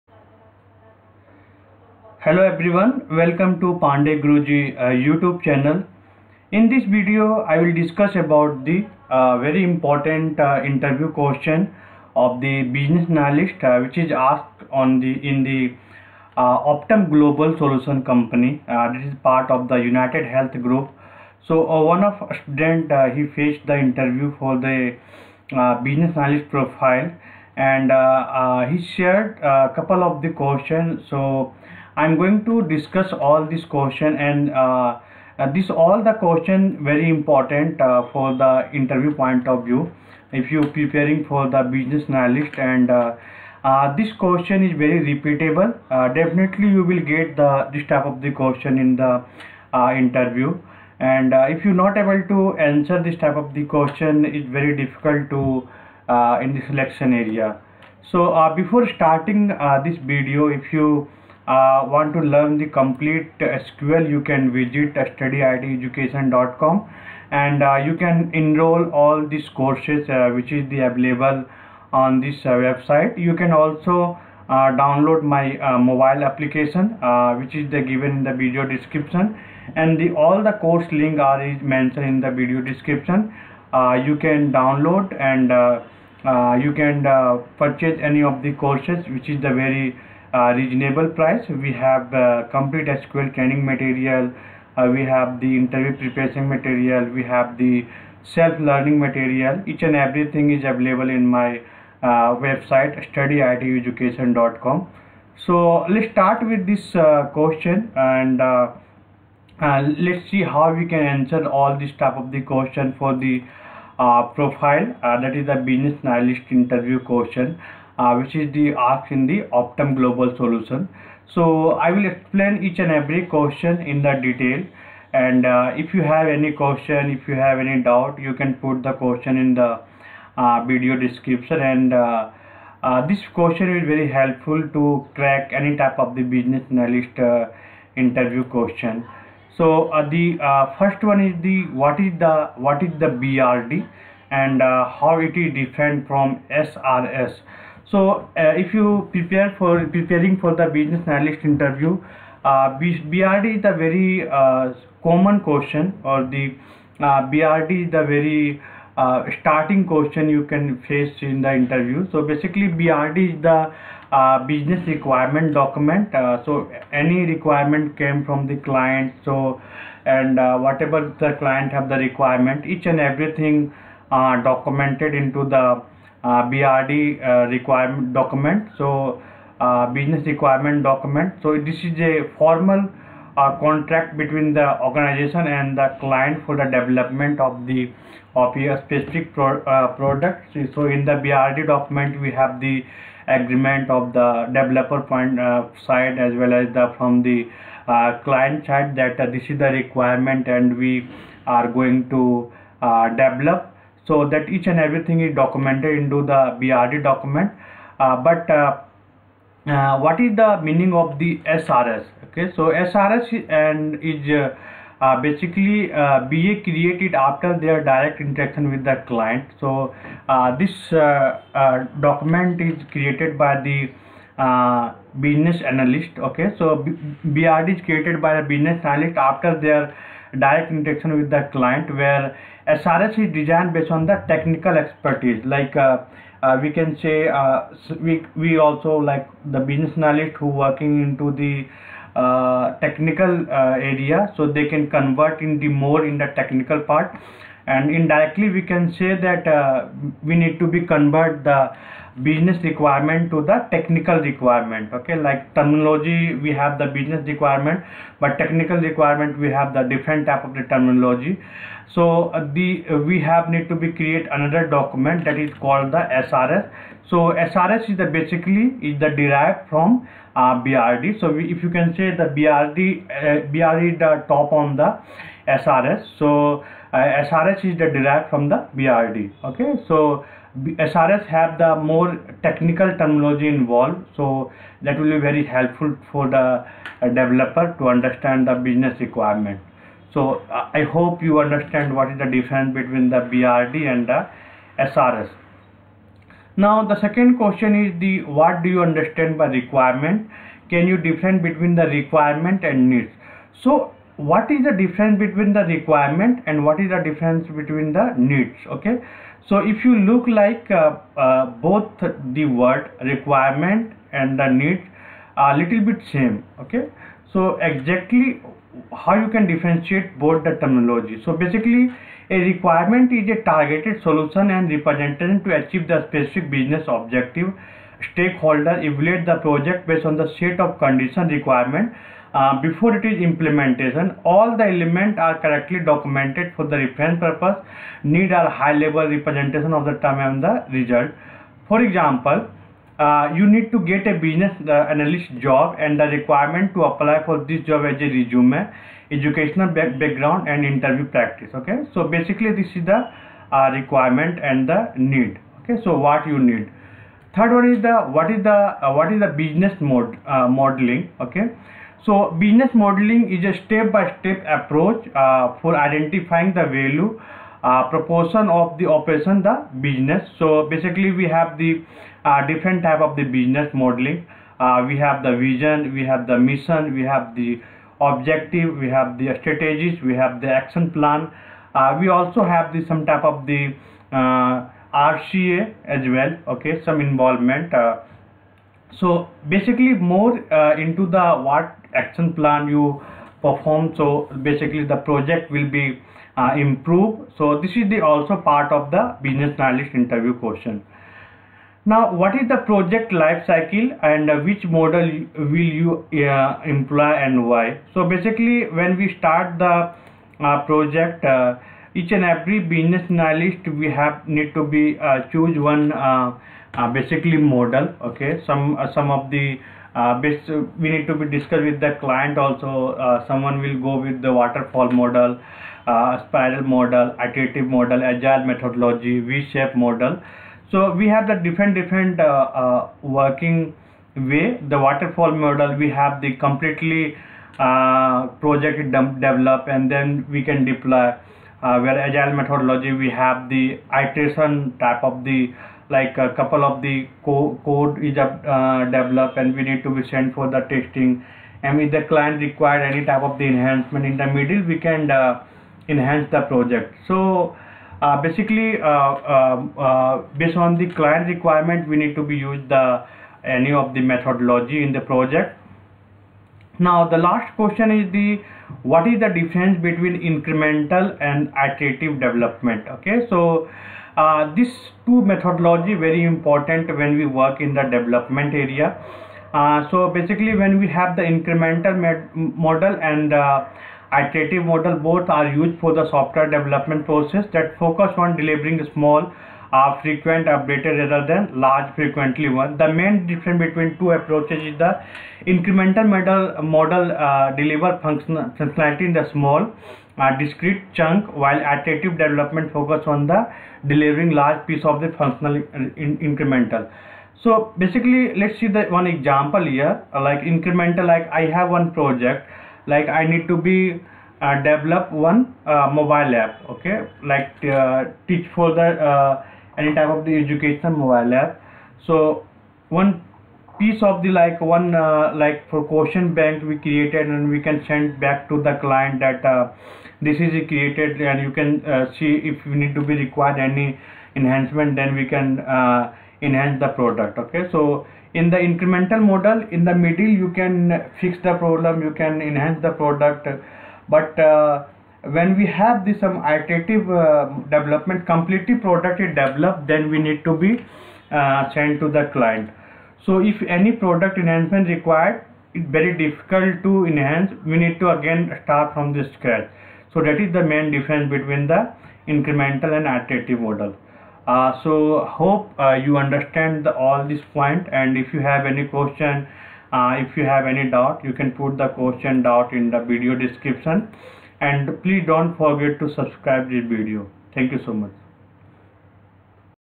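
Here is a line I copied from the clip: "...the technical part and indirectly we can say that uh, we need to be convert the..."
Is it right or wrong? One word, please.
right.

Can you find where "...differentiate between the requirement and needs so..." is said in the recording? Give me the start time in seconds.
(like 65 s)
300 s.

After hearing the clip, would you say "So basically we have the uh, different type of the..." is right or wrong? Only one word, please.
right.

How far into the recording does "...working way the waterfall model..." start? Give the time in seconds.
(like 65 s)
433 s.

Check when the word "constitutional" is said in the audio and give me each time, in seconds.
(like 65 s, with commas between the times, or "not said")
not said.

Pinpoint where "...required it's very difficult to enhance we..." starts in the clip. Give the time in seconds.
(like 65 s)
554 s.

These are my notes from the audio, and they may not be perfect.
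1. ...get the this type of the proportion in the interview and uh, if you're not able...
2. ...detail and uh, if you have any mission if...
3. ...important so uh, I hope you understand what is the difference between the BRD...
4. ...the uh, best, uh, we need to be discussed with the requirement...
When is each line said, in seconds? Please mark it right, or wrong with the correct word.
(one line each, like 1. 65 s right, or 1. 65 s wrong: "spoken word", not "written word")
1. 47 s wrong: "question", not "proportion"
2. 124 s wrong: "question", not "mission"
3. 288 s wrong: "requirement", not "important"
4. 419 s wrong: "client", not "requirement".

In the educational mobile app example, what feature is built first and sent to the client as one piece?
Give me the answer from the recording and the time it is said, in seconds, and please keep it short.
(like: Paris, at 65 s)
Question bank, at 525 s.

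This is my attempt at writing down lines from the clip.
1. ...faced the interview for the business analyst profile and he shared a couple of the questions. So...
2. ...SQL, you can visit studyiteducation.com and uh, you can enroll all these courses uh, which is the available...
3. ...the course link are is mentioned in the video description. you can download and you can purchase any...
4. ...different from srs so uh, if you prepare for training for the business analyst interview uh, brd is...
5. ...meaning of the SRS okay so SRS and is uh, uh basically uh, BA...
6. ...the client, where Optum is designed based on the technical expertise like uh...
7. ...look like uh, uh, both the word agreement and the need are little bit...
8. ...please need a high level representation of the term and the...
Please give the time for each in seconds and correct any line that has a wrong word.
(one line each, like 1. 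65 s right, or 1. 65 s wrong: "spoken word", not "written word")
1. 23 s right
2. 63 s right
3. 80 s right
4. 145 s wrong: "preparing", not "training"
5. 210 s right
6. 231 s wrong: "SRS", not "Optum"
7. 310 s wrong: "requirement", not "agreement"
8. 337 s wrong: "purpose", not "please".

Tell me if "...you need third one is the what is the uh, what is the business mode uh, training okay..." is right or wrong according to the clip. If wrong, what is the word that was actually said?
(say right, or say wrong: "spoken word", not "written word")
wrong: "modeling", not "training".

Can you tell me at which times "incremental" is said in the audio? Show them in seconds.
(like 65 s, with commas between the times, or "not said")
470 s, 481 s, 495 s, 506 s, 510 s, 538 s, 562 s.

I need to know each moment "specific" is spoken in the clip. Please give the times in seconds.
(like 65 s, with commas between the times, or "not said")
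188 s, 326 s.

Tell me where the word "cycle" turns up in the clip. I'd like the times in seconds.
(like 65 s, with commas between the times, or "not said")
403 s.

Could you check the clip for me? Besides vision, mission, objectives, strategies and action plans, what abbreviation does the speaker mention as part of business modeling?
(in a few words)
RCA.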